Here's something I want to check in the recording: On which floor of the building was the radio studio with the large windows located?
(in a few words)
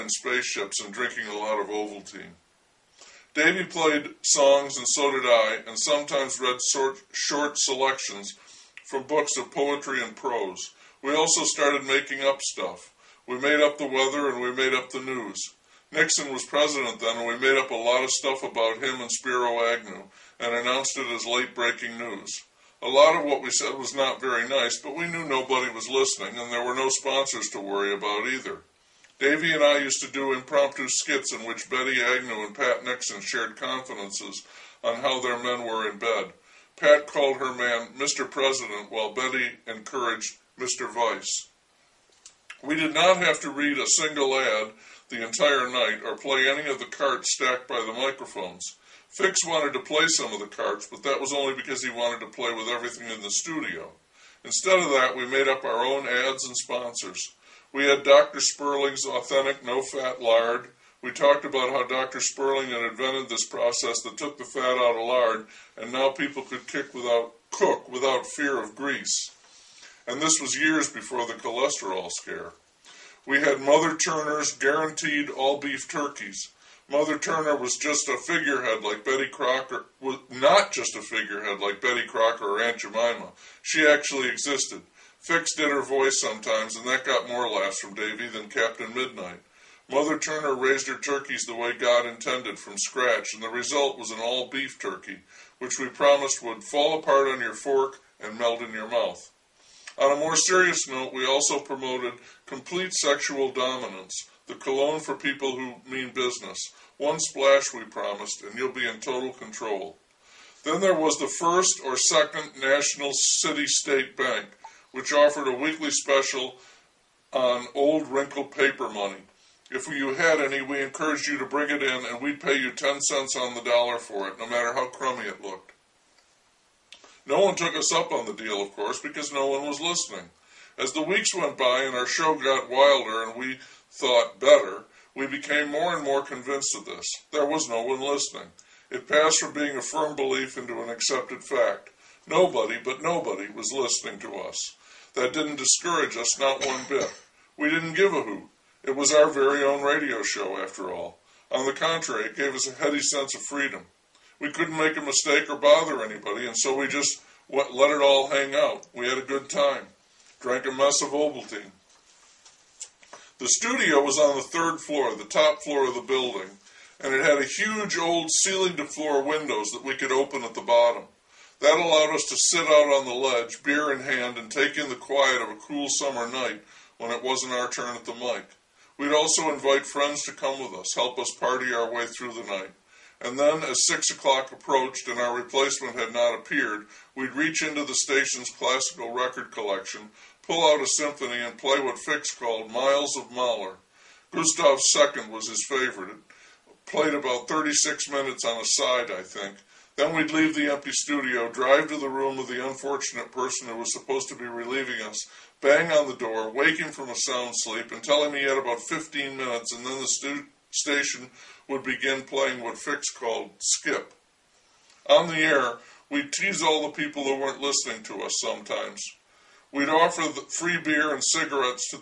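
Third floor.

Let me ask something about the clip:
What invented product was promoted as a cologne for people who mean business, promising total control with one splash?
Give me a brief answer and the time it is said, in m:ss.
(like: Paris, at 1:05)
Complete Sexual Dominance, at 1:42.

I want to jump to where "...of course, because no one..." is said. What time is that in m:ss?
2:08.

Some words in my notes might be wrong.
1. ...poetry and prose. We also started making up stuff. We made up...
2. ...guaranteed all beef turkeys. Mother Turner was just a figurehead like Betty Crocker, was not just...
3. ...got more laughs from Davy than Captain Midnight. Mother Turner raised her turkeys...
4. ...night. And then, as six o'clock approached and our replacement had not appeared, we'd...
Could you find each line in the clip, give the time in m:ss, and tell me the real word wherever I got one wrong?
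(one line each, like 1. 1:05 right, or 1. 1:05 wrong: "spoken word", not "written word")
1. 0:09 right
2. 1:14 right
3. 1:27 right
4. 3:02 right.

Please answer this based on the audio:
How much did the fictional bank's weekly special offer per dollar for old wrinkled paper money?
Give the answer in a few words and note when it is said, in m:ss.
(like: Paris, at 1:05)
10 cents, at 2:02.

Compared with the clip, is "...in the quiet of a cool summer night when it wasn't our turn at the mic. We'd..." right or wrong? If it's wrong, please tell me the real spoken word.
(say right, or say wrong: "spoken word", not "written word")
right.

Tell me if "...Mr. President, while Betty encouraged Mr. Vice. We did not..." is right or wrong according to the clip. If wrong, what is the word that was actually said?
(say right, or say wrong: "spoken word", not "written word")
right.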